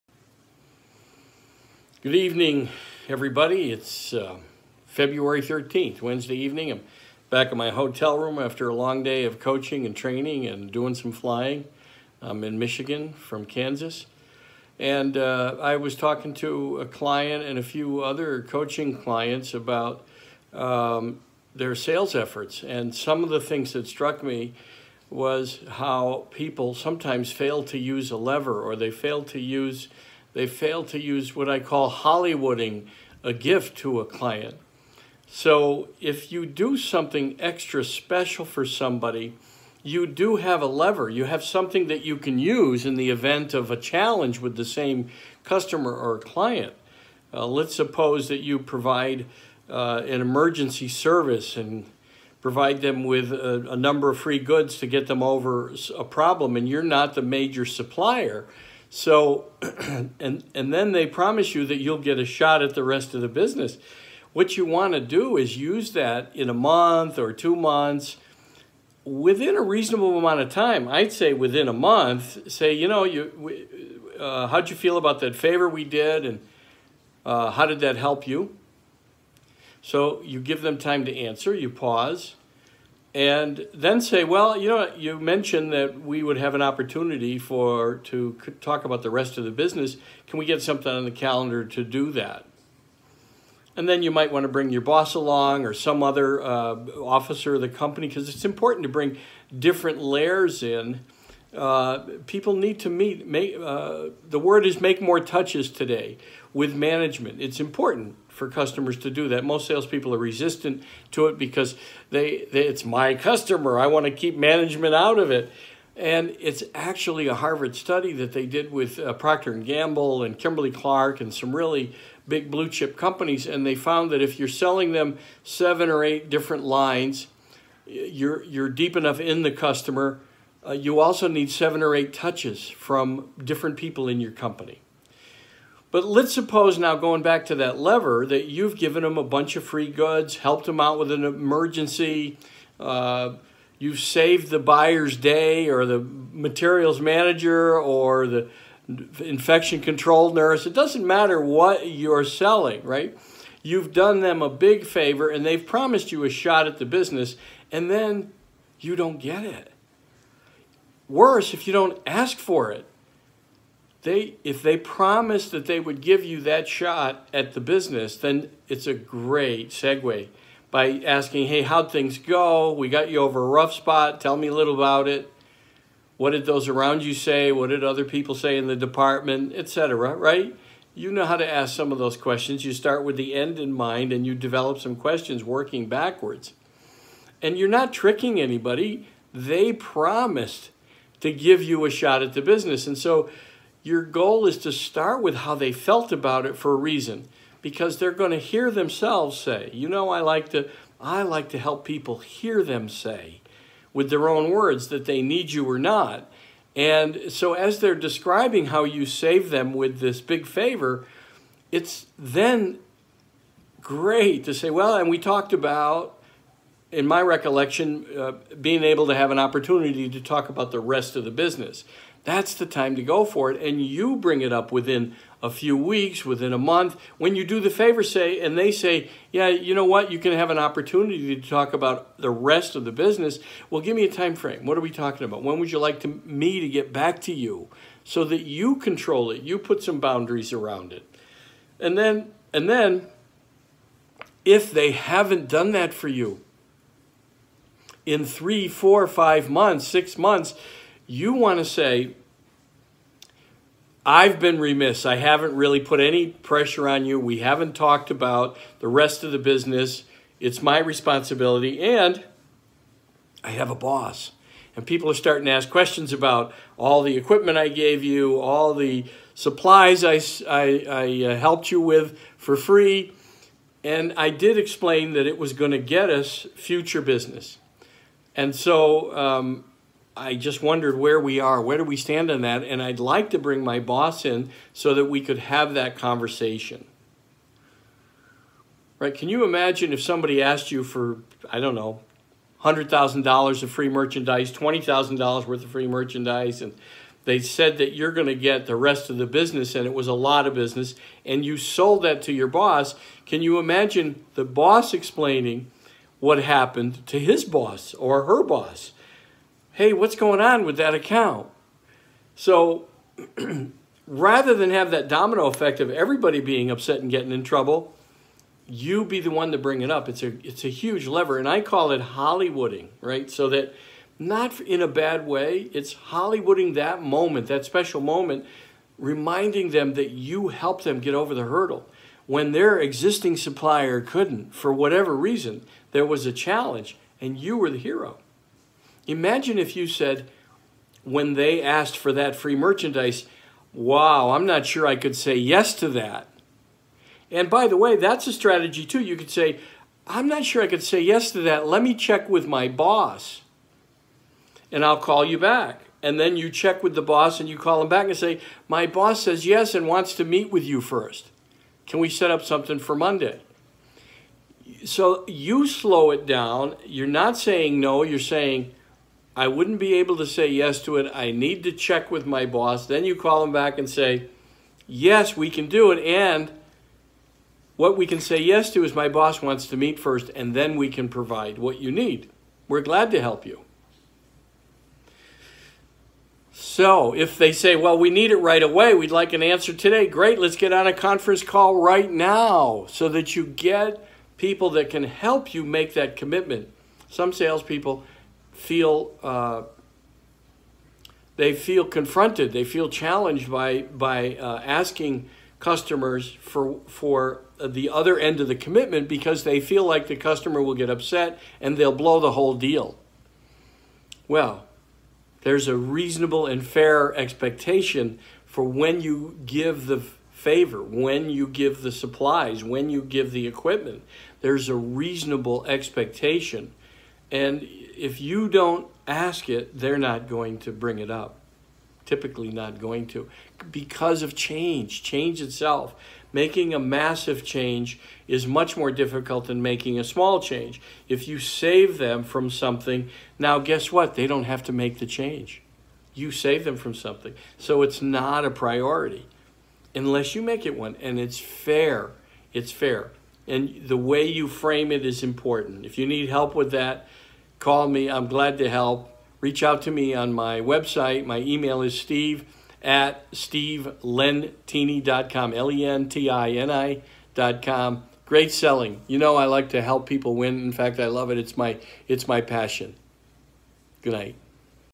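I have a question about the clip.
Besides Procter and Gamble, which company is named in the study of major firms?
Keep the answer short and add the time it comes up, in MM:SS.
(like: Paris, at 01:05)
Kimberly Clark, at 02:00.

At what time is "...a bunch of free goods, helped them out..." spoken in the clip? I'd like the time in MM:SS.
02:19.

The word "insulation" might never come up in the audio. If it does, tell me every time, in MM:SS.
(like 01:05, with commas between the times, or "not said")
not said.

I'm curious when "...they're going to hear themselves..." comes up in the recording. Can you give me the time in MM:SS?
03:17.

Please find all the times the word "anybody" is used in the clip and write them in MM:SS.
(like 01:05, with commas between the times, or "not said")
03:08.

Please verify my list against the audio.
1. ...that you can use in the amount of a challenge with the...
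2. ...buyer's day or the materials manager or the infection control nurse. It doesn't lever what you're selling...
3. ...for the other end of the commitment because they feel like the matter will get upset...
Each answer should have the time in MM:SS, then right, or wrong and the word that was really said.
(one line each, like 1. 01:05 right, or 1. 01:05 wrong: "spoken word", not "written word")
1. 00:41 wrong: "event", not "amount"
2. 02:24 wrong: "matter", not "lever"
3. 06:46 wrong: "customer", not "matter".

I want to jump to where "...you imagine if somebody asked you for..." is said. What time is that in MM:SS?
04:49.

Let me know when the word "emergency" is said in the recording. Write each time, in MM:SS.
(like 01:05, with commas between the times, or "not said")
00:50, 02:21.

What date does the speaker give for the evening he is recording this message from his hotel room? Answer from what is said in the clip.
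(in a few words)
February 13th.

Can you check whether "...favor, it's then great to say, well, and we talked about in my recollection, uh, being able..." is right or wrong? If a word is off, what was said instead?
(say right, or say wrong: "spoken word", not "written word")
right.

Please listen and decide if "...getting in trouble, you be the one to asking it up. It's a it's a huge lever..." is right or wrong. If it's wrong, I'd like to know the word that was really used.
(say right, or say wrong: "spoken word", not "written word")
wrong: "bring", not "asking".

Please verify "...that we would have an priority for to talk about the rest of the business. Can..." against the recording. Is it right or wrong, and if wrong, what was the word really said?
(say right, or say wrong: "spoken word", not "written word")
wrong: "opportunity", not "priority".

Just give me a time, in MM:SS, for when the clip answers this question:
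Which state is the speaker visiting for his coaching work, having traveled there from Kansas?
00:12.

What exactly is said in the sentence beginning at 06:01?
Can we set up something for Monday?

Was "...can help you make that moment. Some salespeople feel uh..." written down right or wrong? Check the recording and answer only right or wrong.
wrong.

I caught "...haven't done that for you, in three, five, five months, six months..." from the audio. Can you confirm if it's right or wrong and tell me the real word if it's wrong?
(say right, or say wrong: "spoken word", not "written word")
wrong: "four", not "five".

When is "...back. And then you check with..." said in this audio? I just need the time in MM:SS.
05:55.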